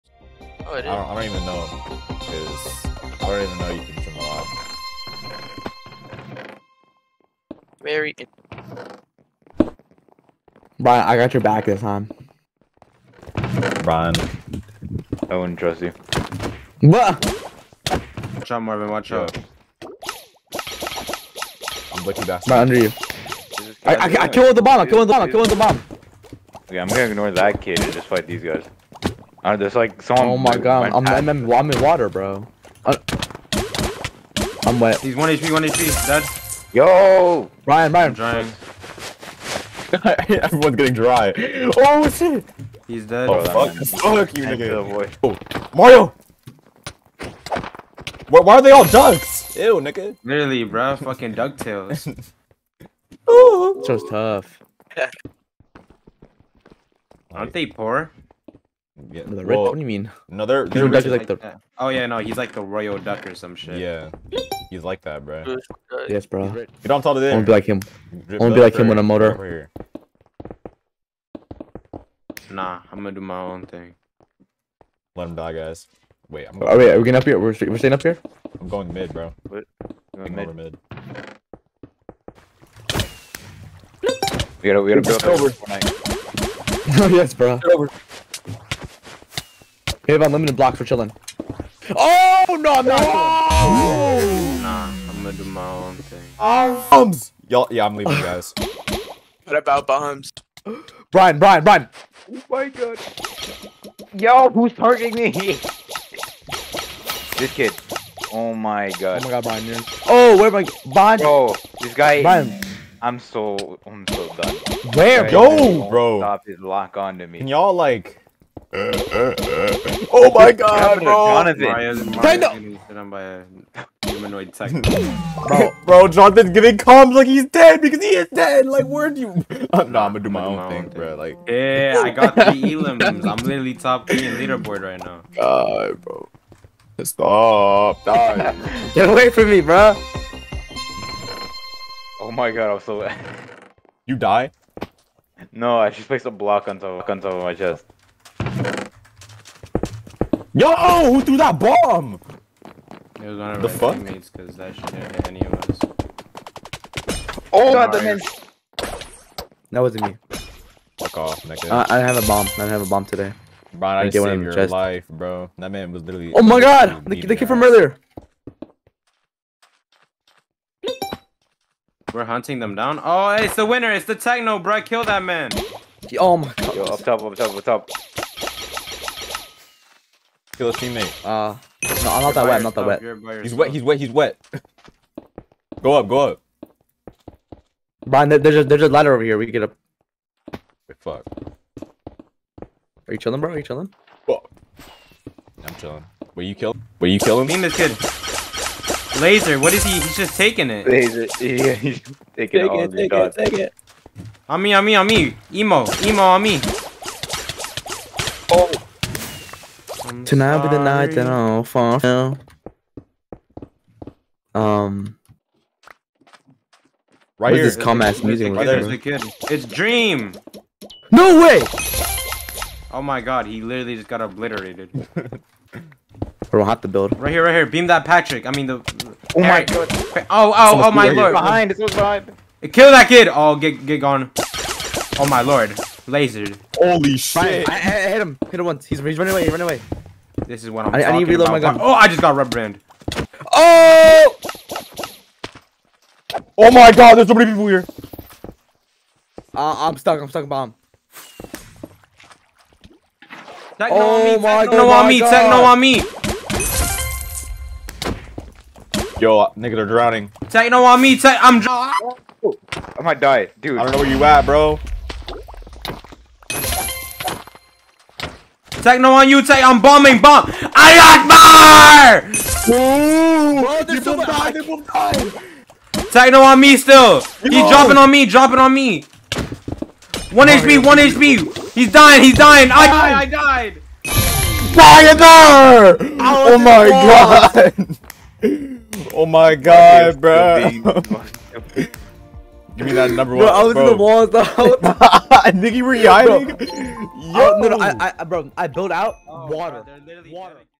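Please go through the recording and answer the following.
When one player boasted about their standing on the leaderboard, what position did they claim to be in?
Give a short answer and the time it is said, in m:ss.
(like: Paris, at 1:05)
top 3, at 2:13.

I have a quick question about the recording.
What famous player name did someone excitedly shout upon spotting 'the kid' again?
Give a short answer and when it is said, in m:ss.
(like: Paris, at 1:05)
Dream, at 3:39.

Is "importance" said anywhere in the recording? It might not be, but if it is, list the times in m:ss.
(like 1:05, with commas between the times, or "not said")
not said.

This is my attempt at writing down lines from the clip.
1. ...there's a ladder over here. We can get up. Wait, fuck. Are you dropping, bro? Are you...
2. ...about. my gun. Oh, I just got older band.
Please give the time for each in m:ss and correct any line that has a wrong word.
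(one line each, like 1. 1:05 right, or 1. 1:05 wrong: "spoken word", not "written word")
1. 3:08 wrong: "chilling", not "dropping"
2. 4:01 wrong: "rubber", not "older".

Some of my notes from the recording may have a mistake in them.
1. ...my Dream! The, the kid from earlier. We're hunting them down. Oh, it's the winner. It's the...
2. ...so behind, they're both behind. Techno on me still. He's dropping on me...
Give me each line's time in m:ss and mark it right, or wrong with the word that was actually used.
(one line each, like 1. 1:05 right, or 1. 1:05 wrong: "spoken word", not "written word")
1. 2:46 wrong: "God", not "Dream"
2. 4:34 right.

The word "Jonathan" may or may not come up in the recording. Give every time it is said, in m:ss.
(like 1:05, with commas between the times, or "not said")
2:01, 2:06.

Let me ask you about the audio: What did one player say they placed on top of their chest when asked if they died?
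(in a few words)
a block.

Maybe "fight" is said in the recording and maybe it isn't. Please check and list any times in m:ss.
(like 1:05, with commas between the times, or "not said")
0:28.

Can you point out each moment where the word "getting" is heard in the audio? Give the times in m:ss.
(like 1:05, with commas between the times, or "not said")
0:40, 1:17.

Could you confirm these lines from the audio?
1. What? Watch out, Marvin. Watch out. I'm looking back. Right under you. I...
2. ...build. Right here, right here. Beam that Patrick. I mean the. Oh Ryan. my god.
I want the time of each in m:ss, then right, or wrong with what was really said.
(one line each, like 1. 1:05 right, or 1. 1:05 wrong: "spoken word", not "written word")
1. 0:16 right
2. 3:46 wrong: "Eric", not "Ryan".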